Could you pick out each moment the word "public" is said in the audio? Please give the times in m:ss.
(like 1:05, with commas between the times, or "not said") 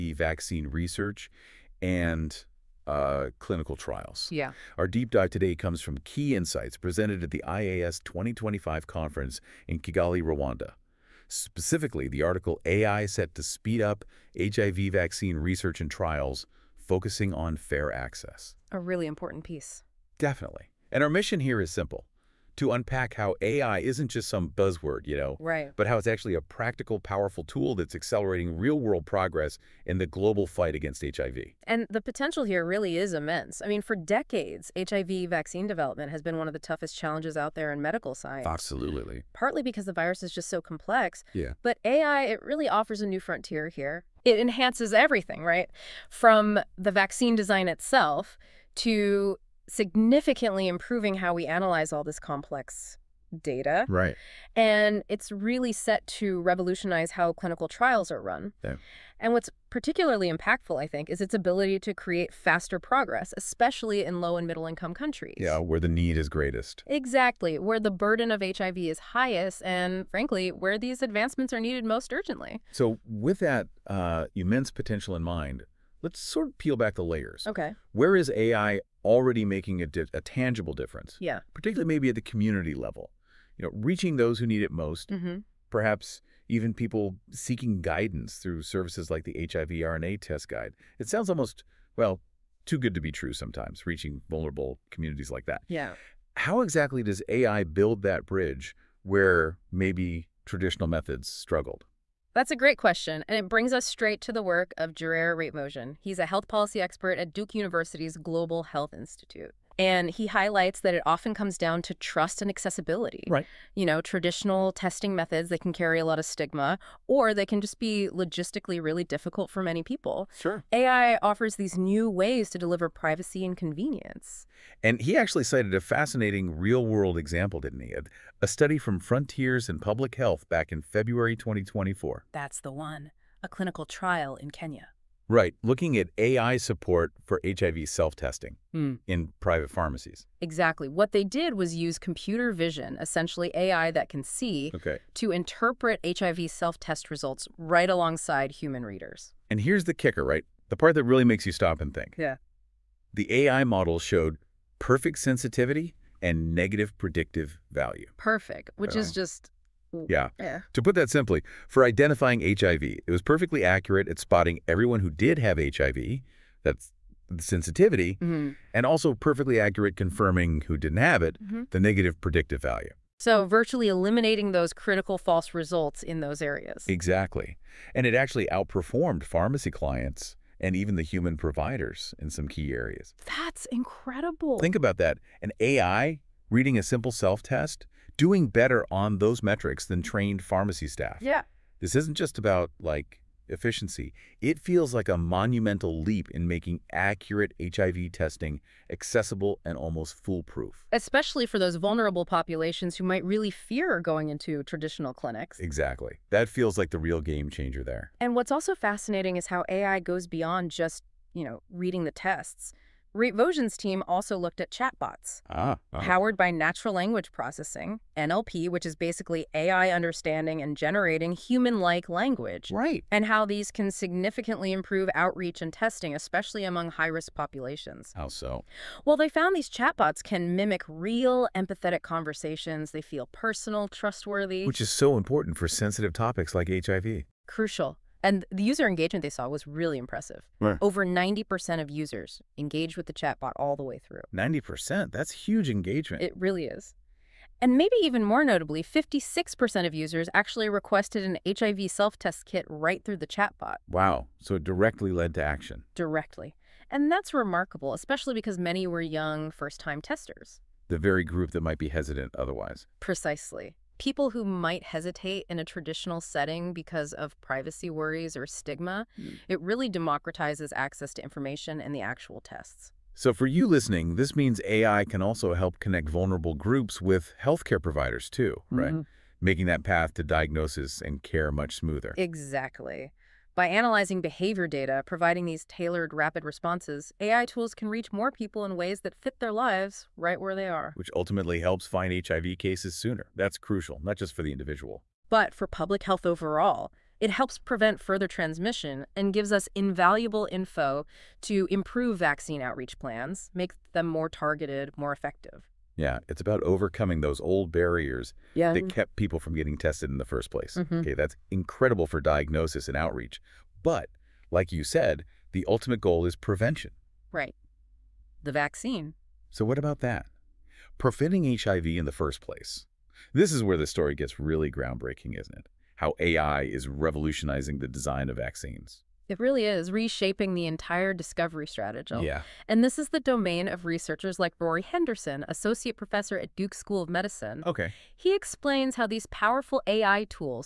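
2:09, 4:55.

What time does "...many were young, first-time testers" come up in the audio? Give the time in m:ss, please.
4:18.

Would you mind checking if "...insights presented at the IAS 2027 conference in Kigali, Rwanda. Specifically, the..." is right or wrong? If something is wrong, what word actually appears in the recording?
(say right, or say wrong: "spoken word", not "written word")
wrong: "2025", not "2027".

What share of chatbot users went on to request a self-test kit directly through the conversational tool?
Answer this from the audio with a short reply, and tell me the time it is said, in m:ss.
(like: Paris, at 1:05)
56%, at 4:08.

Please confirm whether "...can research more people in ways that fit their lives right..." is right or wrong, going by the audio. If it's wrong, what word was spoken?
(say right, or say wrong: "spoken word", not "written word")
wrong: "reach", not "research".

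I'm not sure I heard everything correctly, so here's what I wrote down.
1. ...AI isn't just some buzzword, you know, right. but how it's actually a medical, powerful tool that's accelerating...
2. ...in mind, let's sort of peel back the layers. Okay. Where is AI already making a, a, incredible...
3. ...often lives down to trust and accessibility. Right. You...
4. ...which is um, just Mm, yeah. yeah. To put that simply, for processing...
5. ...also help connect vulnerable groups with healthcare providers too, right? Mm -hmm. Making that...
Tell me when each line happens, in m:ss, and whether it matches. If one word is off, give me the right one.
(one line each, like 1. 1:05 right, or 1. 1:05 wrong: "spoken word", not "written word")
1. 0:23 wrong: "practical", not "medical"
2. 1:15 wrong: "tangible", not "incredible"
3. 1:51 wrong: "comes", not "lives"
4. 2:38 wrong: "identifying", not "processing"
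5. 4:35 right.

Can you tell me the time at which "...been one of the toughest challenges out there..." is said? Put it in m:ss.
0:36.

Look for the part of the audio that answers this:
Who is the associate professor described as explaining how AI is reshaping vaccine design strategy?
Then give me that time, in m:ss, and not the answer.
5:34.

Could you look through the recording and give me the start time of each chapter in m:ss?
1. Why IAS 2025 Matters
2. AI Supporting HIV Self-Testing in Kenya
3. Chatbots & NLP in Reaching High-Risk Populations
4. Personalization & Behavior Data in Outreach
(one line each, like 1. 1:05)
1. 0:37
2. 1:40
3. 3:35
4. 5:20.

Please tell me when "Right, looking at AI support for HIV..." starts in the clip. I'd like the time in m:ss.
2:15.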